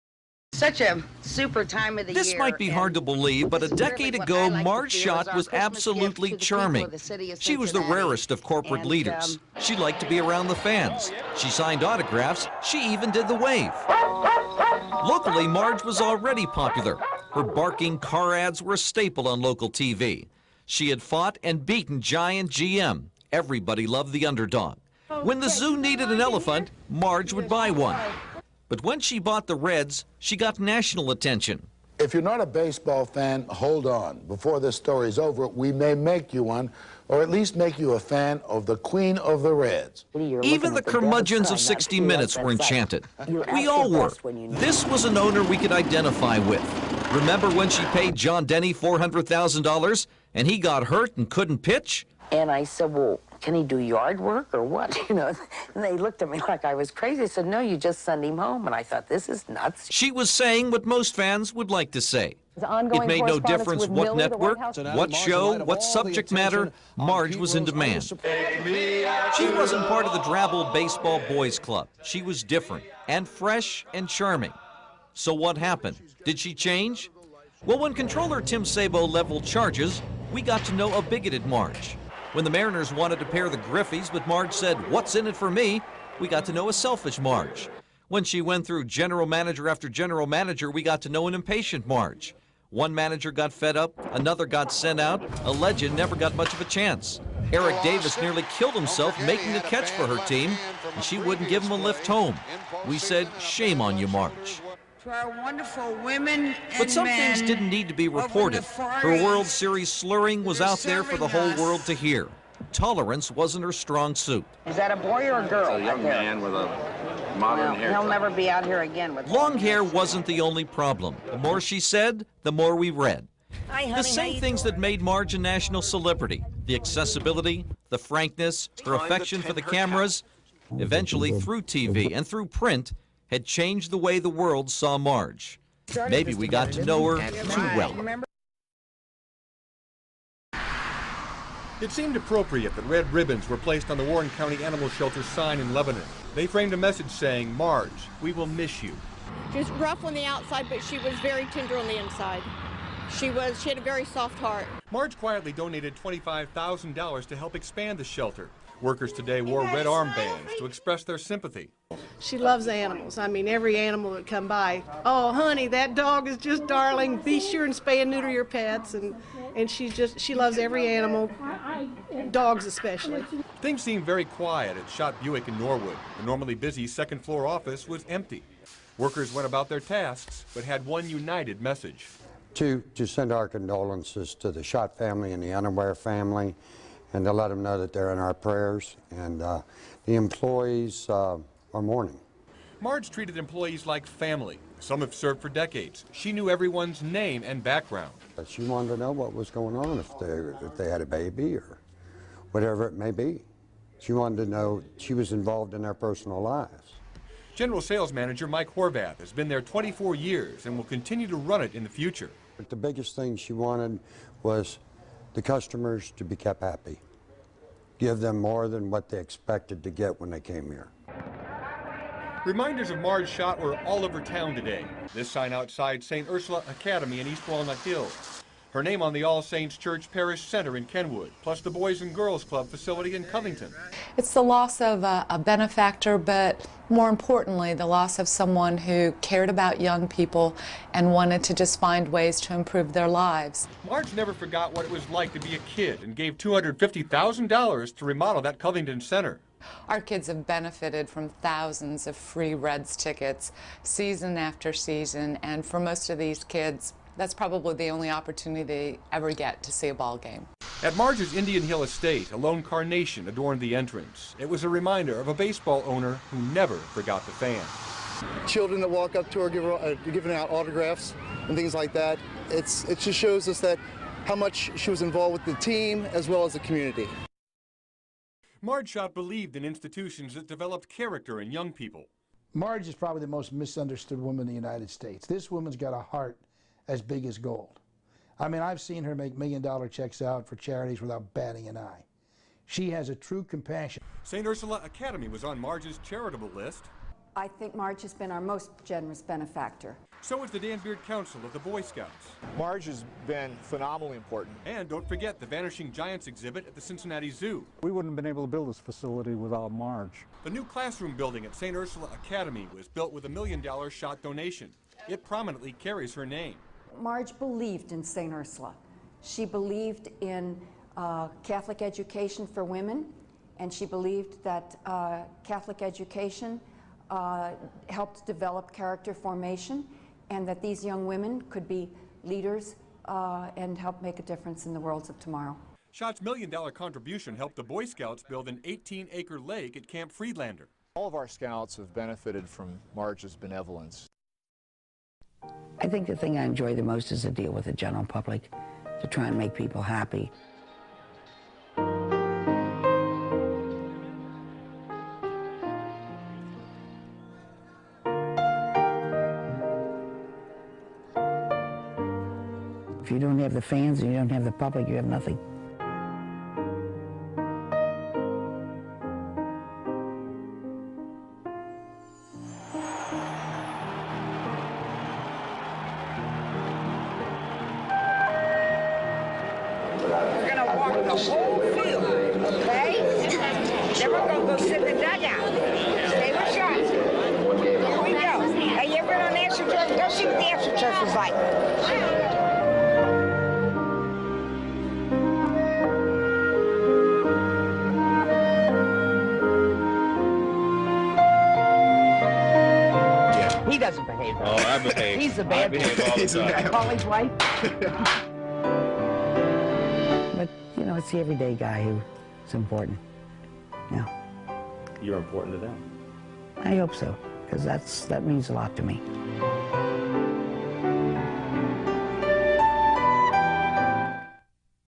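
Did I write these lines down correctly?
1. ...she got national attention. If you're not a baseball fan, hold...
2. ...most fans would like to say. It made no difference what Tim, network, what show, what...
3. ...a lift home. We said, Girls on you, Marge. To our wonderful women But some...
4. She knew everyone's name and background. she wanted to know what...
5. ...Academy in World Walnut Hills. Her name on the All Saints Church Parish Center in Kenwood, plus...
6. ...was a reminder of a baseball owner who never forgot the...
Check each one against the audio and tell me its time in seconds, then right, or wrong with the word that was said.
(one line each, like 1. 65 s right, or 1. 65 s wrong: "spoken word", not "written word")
1. 30 s right
2. 60 s wrong: "Miller", not "Tim"
3. 101 s wrong: "Shame", not "Girls"
4. 196 s right
5. 226 s wrong: "East", not "World"
6. 264 s right.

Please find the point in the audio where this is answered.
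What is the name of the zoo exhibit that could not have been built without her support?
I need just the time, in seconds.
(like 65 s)
305 s.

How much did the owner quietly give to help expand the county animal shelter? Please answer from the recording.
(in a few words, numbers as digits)
$25,000.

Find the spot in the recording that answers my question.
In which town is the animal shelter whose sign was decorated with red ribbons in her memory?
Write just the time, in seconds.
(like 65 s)
145 s.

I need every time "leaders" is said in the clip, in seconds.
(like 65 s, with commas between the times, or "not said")
8 s, 332 s.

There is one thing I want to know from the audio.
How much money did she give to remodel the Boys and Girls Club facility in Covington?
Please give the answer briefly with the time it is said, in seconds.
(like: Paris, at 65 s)
$250,000, at 246 s.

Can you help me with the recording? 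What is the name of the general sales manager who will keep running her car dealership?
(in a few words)
Mike Horvath.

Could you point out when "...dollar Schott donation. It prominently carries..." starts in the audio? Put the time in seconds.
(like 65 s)
313 s.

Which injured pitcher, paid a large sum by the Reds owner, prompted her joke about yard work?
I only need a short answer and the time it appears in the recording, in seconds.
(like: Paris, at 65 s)
John Denny, at 48 s.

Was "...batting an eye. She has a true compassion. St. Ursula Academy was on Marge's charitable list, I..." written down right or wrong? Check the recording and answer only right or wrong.
right.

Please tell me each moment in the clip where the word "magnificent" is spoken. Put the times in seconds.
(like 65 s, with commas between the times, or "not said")
not said.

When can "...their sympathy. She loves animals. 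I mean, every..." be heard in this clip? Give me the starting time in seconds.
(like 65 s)
161 s.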